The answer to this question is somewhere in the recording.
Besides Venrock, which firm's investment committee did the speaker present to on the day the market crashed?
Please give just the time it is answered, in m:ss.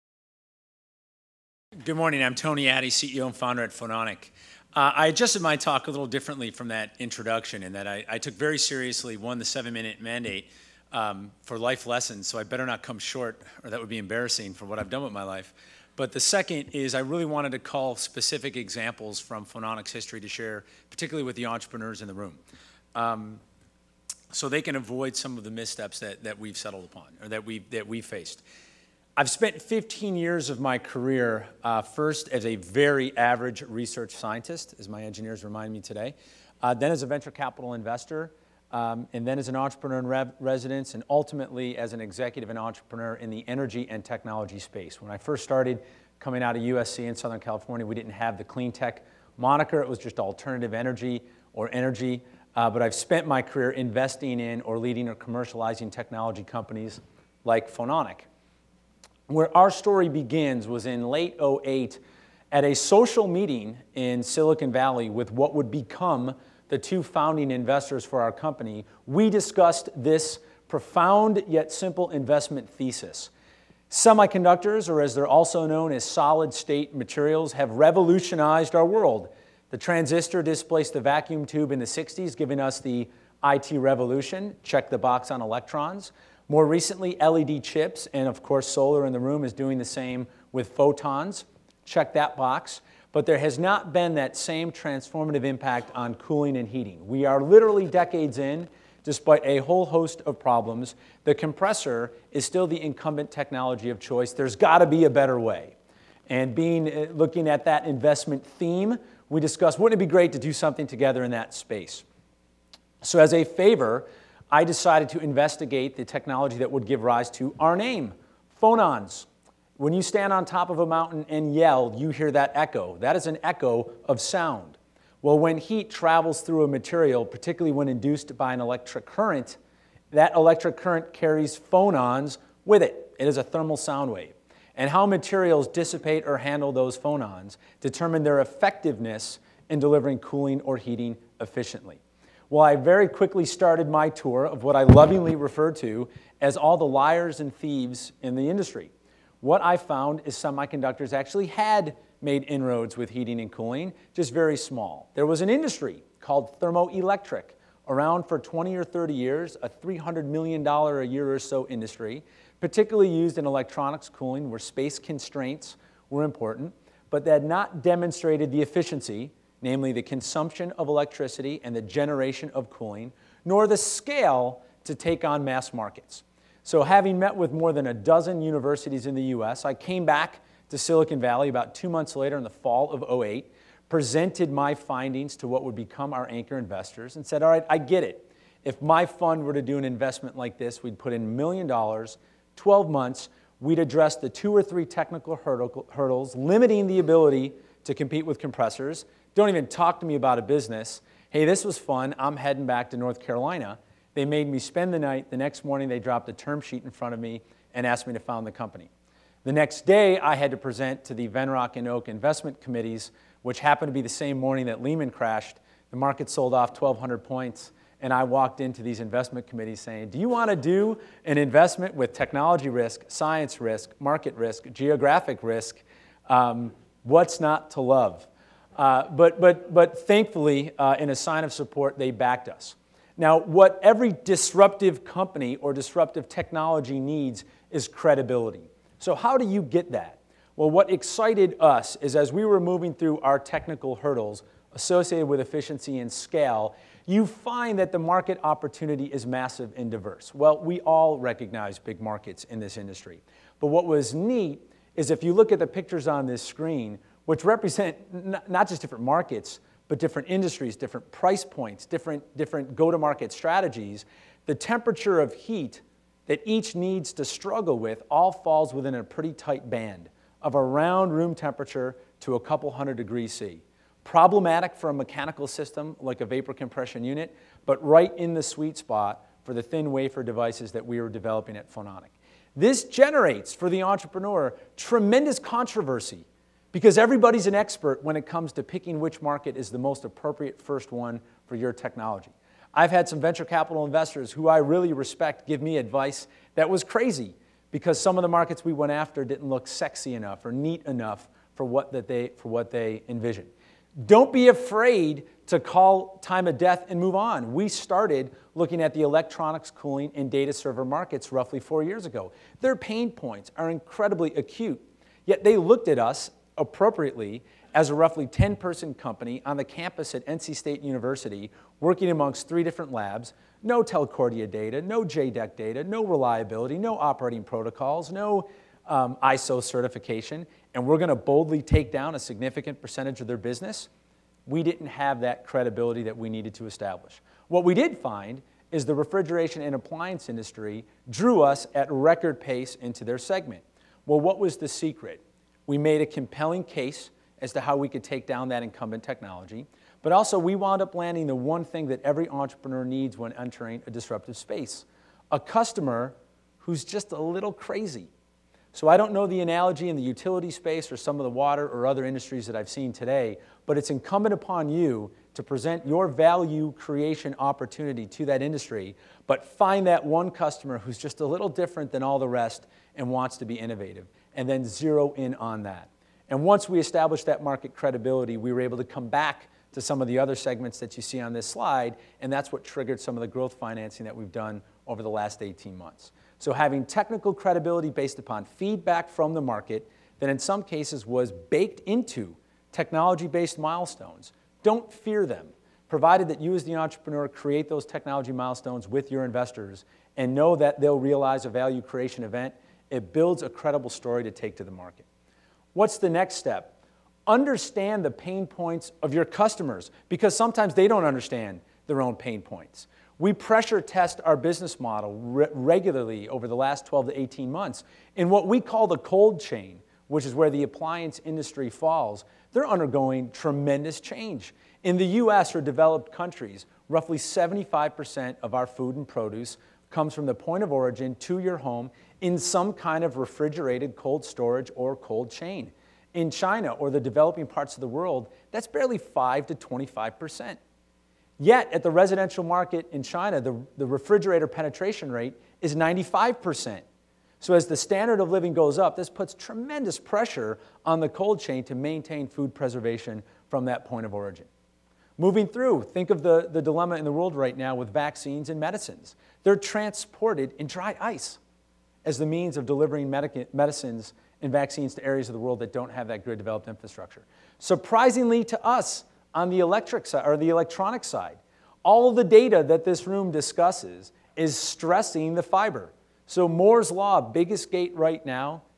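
3:31.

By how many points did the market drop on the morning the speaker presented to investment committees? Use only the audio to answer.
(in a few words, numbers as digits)
1,200 points.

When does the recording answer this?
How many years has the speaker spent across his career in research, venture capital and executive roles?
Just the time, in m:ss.
0:29.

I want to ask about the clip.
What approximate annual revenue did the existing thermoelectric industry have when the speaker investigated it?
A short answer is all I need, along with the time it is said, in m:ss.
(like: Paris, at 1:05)
$300 million, at 2:39.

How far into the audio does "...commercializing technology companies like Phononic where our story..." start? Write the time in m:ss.
0:55.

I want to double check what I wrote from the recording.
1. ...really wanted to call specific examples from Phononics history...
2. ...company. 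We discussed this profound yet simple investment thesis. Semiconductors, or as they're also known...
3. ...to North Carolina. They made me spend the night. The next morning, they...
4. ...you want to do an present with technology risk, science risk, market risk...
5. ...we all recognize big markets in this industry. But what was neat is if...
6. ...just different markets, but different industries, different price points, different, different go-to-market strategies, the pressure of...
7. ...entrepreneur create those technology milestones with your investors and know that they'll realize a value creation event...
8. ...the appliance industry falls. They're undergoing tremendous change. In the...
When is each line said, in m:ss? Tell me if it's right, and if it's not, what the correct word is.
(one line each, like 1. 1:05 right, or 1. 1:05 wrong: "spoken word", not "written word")
1. 0:17 right
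2. 1:08 right
3. 3:22 right
4. 3:40 wrong: "investment", not "present"
5. 4:10 right
6. 4:18 wrong: "temperature", not "pressure"
7. 6:36 right
8. 7:00 right.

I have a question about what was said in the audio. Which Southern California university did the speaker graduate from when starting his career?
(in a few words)
USC.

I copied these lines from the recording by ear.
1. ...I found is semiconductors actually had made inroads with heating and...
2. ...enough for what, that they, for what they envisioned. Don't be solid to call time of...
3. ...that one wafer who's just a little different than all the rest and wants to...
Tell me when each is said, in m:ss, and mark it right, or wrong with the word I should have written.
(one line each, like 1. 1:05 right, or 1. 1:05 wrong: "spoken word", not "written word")
1. 2:29 right
2. 5:00 wrong: "afraid", not "solid"
3. 6:09 wrong: "customer", not "wafer".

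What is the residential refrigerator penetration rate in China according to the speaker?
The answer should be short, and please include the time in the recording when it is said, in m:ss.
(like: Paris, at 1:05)
95%, at 7:25.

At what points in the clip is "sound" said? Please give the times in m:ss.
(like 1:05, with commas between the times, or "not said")
2:04, 2:13.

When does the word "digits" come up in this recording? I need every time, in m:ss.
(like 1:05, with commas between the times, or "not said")
not said.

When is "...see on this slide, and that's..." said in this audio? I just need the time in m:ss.
6:21.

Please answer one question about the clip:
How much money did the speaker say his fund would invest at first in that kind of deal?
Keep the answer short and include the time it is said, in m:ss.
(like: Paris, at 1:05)
1 million dollars, at 3:11.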